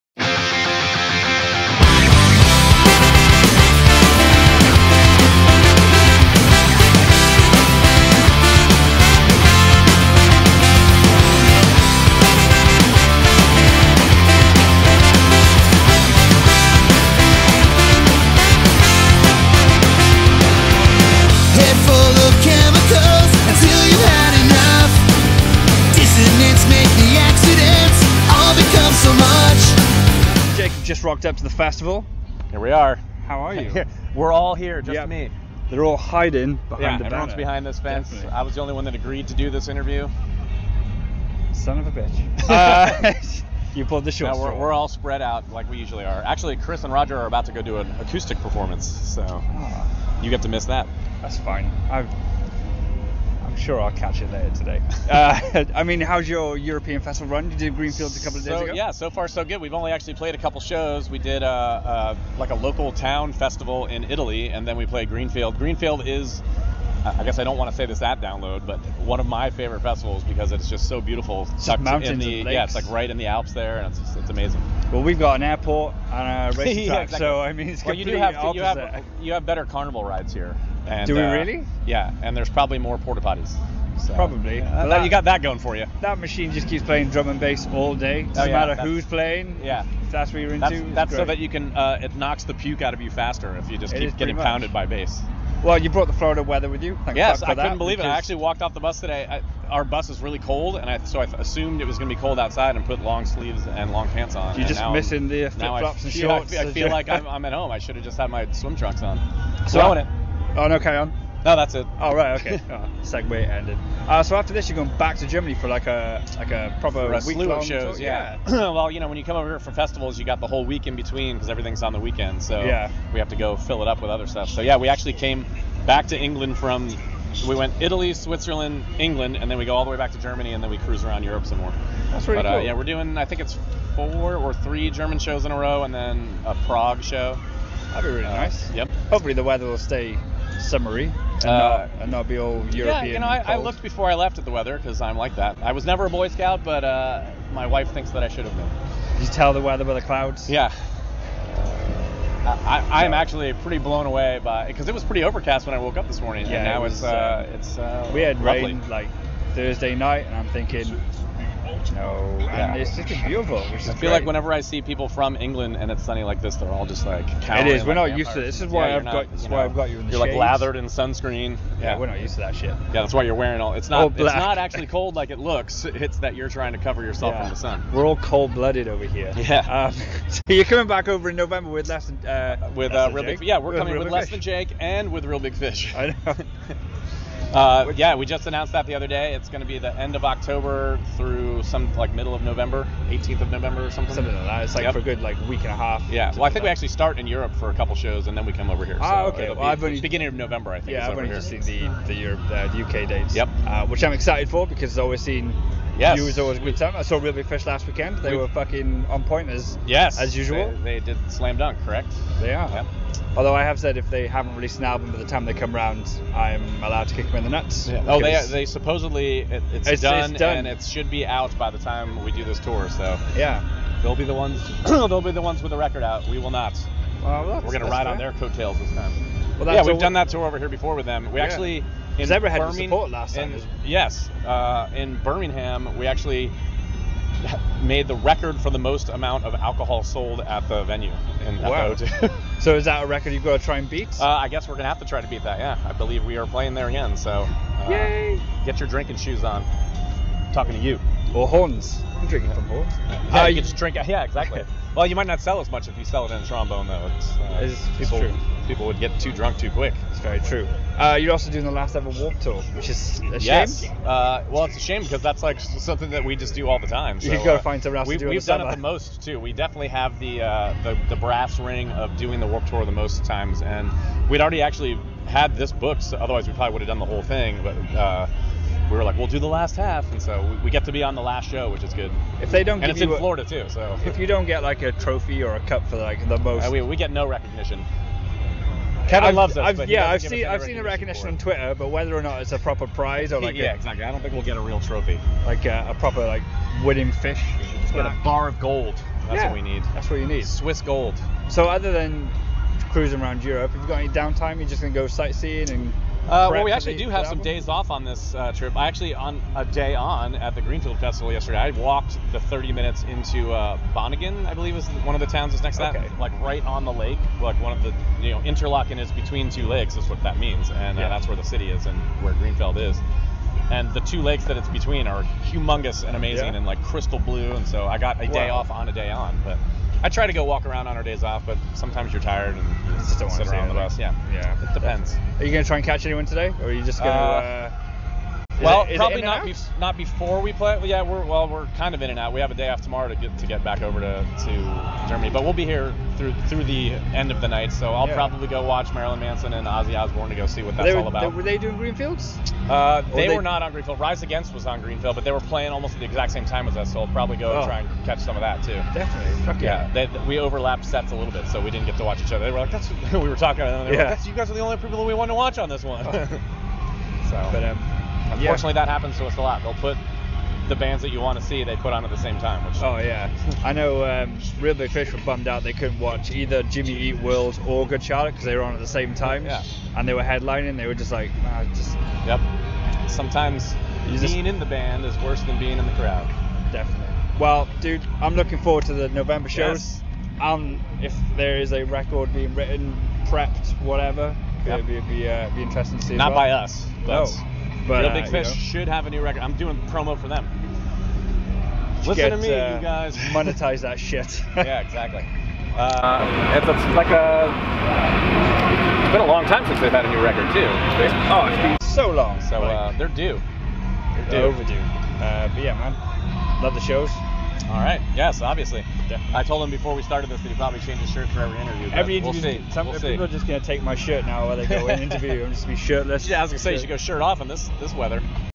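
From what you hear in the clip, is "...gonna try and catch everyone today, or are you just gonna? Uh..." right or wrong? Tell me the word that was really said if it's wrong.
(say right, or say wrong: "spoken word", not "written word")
wrong: "anyone", not "everyone".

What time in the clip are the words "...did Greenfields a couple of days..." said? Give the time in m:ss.
0:57.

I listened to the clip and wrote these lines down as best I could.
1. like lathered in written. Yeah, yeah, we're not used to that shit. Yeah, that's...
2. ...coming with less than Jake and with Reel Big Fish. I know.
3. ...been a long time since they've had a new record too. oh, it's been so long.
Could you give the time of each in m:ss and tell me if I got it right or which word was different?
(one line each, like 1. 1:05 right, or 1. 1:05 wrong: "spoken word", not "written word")
1. 2:50 wrong: "sunscreen", not "written"
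2. 3:03 right
3. 6:49 right.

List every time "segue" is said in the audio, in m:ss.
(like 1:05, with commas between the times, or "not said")
1:53.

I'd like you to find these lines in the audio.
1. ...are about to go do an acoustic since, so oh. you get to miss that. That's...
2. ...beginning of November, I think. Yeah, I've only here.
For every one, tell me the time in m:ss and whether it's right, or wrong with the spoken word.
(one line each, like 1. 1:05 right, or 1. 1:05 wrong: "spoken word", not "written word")
1. 0:47 wrong: "performance", not "since"
2. 3:19 right.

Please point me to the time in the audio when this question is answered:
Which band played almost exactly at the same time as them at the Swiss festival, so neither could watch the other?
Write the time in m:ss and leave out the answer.
5:53.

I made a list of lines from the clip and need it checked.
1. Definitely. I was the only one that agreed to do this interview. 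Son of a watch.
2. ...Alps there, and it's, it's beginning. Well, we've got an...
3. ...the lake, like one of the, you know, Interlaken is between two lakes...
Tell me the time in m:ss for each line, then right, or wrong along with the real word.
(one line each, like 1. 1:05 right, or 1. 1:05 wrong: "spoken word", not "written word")
1. 0:38 wrong: "bitch", not "watch"
2. 1:13 wrong: "amazing", not "beginning"
3. 5:16 right.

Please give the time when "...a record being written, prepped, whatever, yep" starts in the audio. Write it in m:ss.
6:31.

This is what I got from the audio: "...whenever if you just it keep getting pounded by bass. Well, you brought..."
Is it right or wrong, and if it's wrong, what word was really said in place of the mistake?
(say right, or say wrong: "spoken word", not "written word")
wrong: "faster", not "whenever".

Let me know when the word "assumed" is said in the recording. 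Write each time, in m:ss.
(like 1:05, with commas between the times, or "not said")
1:41.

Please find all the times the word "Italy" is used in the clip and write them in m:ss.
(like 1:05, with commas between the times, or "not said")
1:04, 2:07.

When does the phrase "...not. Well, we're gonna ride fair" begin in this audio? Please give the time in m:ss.
3:46.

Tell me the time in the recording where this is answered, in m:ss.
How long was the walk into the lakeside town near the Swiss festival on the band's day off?
5:12.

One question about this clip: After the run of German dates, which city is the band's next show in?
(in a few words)
Prague.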